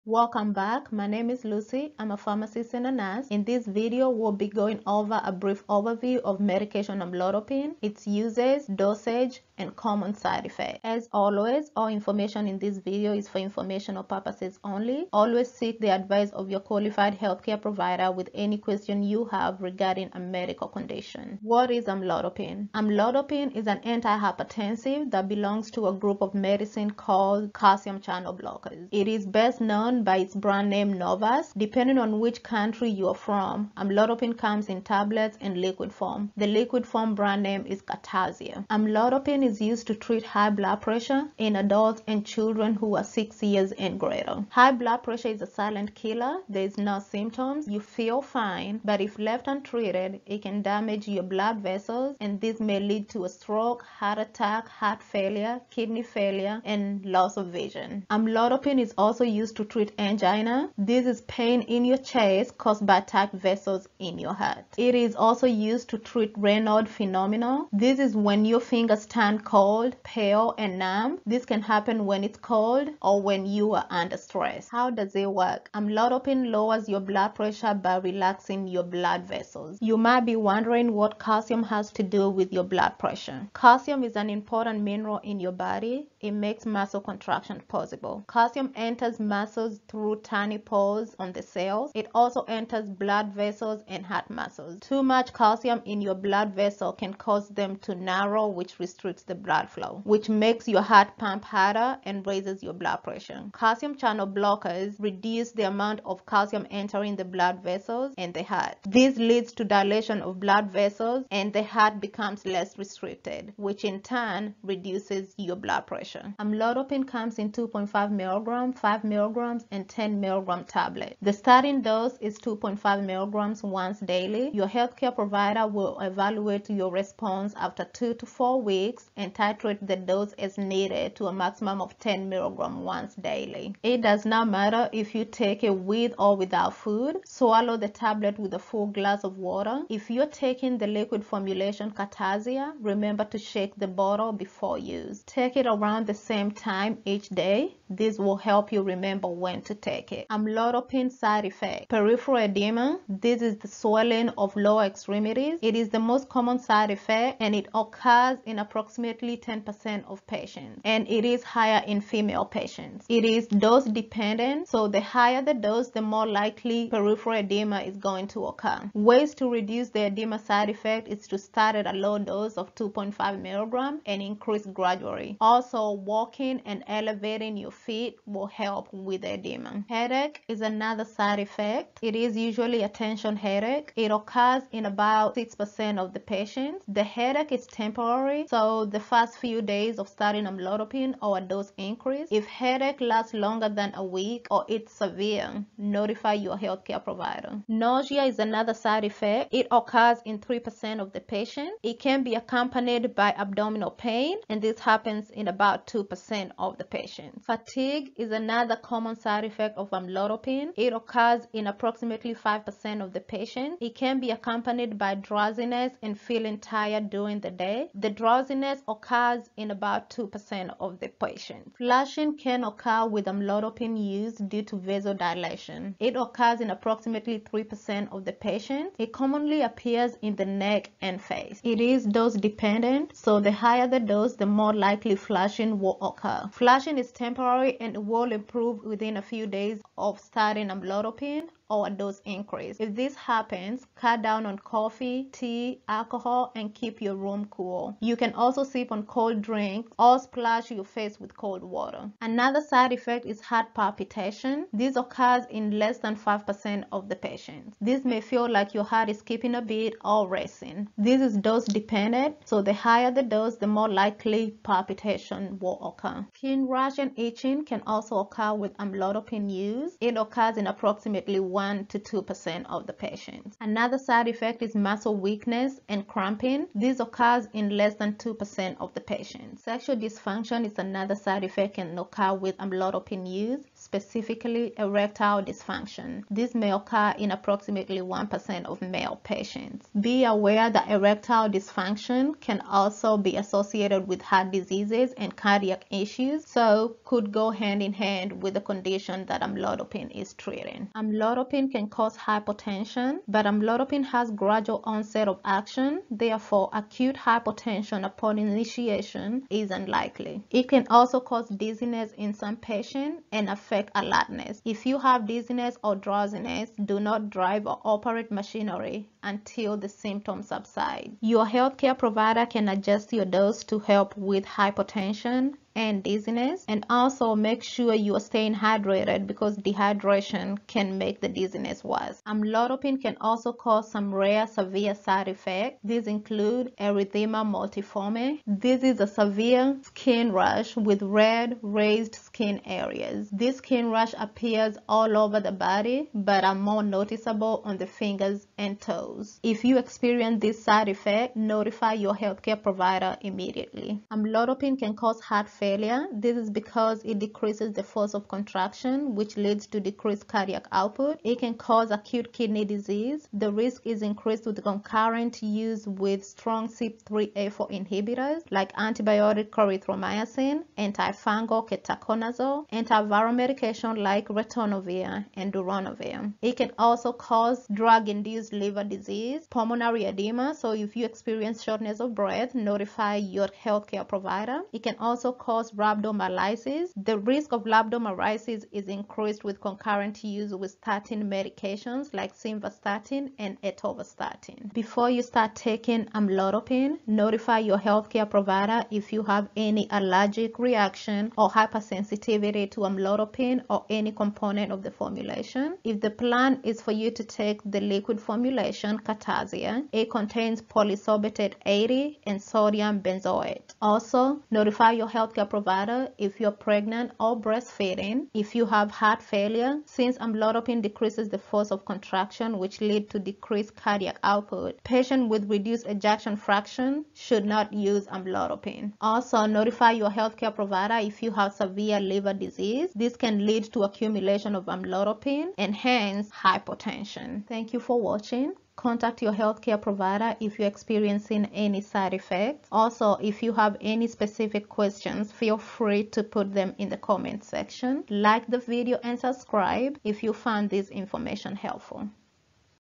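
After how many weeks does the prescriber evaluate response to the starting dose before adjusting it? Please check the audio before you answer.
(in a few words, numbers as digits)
2 to 4.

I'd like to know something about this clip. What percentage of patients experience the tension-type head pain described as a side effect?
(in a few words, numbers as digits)
6%.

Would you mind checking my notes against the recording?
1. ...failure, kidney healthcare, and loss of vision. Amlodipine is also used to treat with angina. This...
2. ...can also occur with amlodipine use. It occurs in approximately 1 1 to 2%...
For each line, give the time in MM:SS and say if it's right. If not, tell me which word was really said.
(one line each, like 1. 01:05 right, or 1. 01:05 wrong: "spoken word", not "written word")
1. 00:55 wrong: "failure", not "healthcare"
2. 04:27 right.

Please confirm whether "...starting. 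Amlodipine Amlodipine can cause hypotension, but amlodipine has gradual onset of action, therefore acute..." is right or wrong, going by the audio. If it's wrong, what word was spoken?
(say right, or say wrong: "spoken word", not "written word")
wrong: "treating", not "starting".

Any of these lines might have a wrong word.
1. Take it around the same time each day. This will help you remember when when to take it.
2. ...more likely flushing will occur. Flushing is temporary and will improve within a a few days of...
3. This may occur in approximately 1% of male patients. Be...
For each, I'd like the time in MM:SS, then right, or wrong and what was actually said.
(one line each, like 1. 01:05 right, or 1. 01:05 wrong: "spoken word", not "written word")
1. 02:25 right
2. 03:54 right
3. 04:46 right.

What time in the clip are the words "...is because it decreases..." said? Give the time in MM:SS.
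05:56.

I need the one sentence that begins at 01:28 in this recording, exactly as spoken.
Calcium enters muscles through tiny pores on the cells.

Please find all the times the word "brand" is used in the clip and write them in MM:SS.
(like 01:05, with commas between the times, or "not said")
00:30, 00:37.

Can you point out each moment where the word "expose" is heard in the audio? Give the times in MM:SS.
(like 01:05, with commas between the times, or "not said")
not said.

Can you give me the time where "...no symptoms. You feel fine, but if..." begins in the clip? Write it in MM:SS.
00:46.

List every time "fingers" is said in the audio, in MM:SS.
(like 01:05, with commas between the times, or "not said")
01:08, 05:47.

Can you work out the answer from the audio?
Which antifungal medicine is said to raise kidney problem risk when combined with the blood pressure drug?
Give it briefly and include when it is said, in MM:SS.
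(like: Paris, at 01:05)
ketoconazole, at 06:10.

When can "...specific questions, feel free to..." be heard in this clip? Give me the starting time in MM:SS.
07:24.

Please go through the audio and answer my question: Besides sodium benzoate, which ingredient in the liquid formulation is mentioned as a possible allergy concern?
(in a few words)
polysorbate 80.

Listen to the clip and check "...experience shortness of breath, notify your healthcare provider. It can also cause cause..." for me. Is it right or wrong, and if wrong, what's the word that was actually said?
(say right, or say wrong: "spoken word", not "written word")
right.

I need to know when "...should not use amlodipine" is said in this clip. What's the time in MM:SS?
07:07.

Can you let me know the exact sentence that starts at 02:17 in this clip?
Swallow the tablet with a full glass of water.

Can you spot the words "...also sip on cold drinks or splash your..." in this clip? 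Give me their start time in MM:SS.
04:08.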